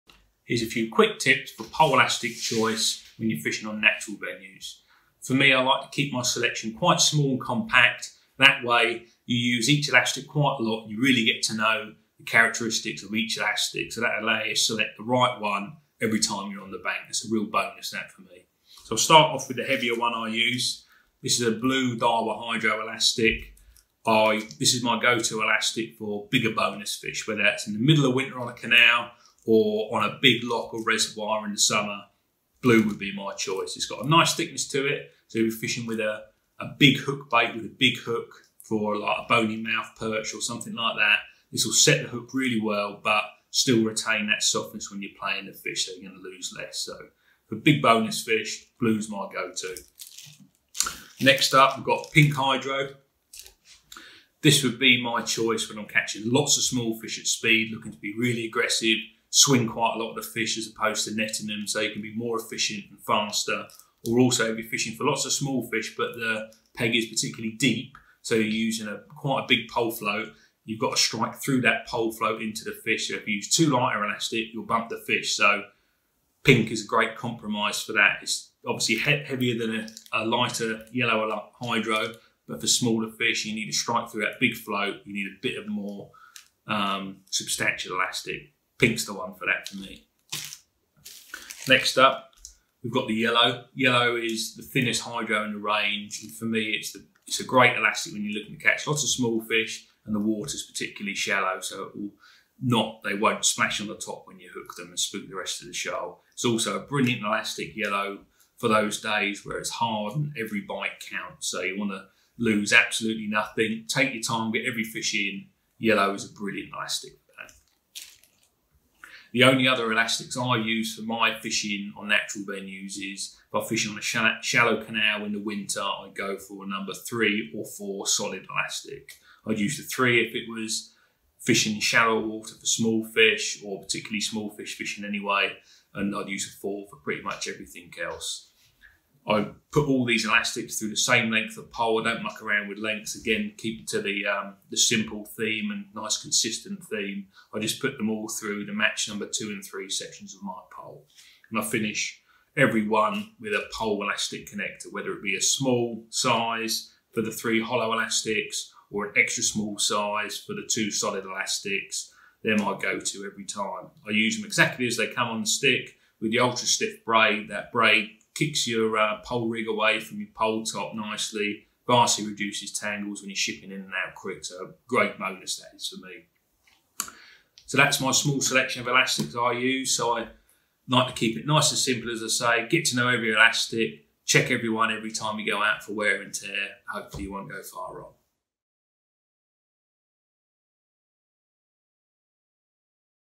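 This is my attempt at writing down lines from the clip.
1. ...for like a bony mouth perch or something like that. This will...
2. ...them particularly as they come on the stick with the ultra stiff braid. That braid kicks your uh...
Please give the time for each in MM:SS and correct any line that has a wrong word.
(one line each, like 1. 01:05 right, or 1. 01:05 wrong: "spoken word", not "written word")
1. 00:38 right
2. 02:44 wrong: "exactly", not "particularly".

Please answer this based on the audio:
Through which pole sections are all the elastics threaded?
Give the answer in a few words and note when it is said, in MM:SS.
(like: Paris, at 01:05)
Match number 2 and 3 sections, at 02:28.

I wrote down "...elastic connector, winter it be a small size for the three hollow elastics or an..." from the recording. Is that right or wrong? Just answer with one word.
wrong.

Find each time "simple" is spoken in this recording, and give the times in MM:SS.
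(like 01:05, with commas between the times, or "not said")
02:24, 03:01.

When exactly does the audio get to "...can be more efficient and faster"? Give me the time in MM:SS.
01:01.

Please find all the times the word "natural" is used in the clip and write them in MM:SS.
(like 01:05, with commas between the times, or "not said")
00:03, 02:02.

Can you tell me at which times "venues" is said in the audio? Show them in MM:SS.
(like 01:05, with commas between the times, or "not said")
00:04, 02:02.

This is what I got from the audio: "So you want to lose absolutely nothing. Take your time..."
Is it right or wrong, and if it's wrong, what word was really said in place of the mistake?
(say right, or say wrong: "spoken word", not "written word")
right.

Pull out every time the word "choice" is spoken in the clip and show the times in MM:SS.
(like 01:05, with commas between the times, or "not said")
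00:02, 00:33, 00:55.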